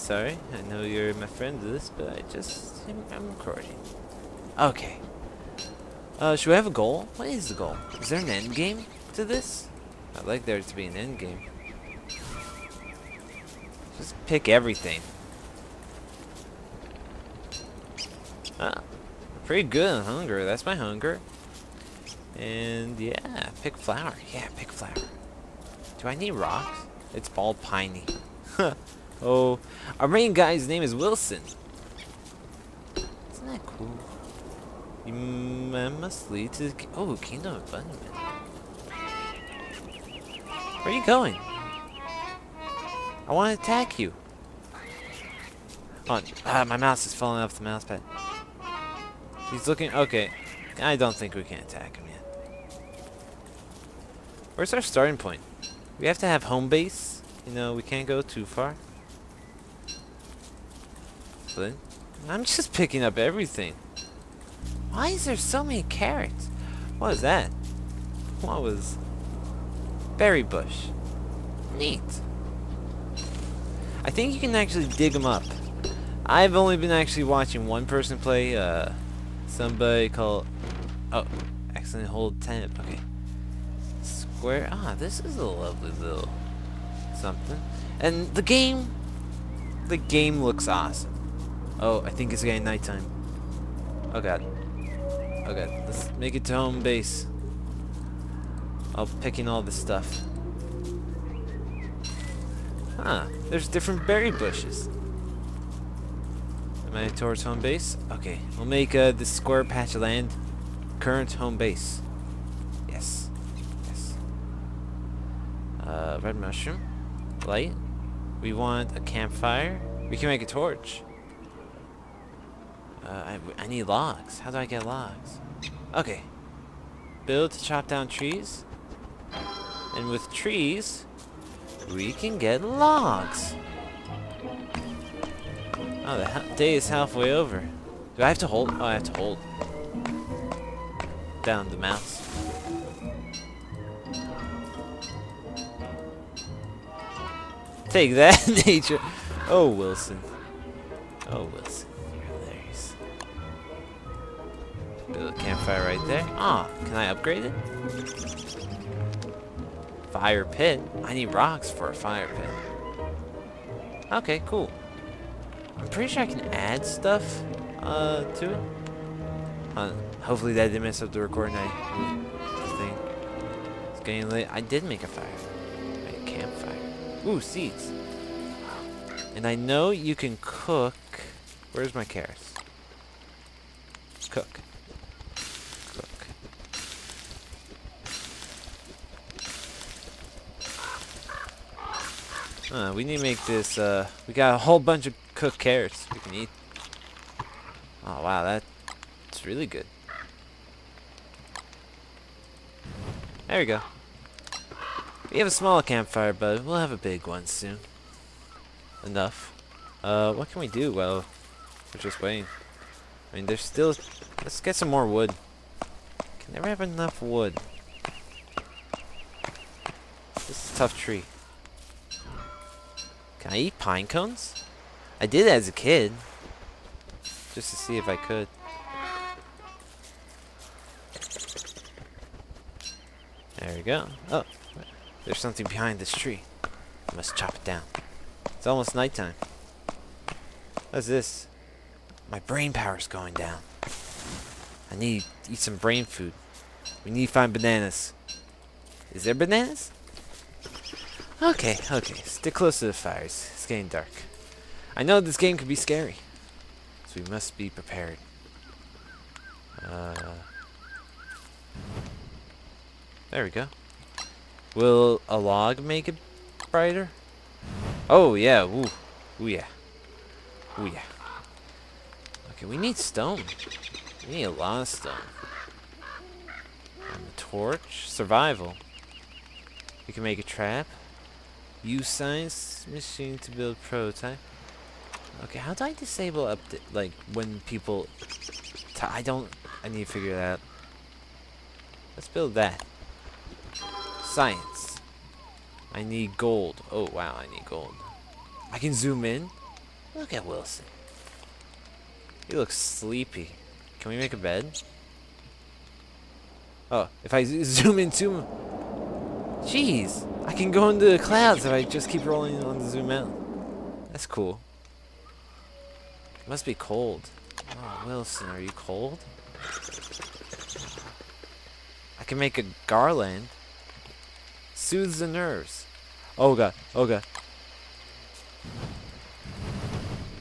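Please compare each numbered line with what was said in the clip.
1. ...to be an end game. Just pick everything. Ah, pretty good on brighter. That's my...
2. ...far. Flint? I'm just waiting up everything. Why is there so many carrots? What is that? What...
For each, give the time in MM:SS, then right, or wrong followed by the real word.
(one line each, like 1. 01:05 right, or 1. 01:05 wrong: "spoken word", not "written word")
1. 00:10 wrong: "hunger", not "brighter"
2. 00:58 wrong: "picking", not "waiting".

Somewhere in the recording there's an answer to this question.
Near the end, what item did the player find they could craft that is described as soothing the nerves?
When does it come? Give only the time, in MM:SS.
05:22.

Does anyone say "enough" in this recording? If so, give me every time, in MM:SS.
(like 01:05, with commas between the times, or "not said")
03:29, 03:36.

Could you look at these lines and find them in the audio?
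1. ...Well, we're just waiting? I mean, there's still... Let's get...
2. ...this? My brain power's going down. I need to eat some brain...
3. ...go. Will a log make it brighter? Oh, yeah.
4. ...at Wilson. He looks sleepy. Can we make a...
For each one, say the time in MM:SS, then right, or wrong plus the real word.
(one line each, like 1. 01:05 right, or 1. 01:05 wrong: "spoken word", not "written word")
1. 03:30 right
2. 04:01 right
3. 04:23 right
4. 05:00 right.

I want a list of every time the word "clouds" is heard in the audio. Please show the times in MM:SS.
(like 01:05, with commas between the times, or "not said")
05:11.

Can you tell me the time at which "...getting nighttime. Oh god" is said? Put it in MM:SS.
01:32.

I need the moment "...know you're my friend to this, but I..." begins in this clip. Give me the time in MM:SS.
00:00.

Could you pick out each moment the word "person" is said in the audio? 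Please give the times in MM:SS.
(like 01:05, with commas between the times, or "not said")
01:17.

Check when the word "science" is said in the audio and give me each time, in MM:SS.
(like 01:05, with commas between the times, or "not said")
04:42, 04:54.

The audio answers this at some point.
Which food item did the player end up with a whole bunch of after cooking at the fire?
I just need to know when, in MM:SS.
03:15.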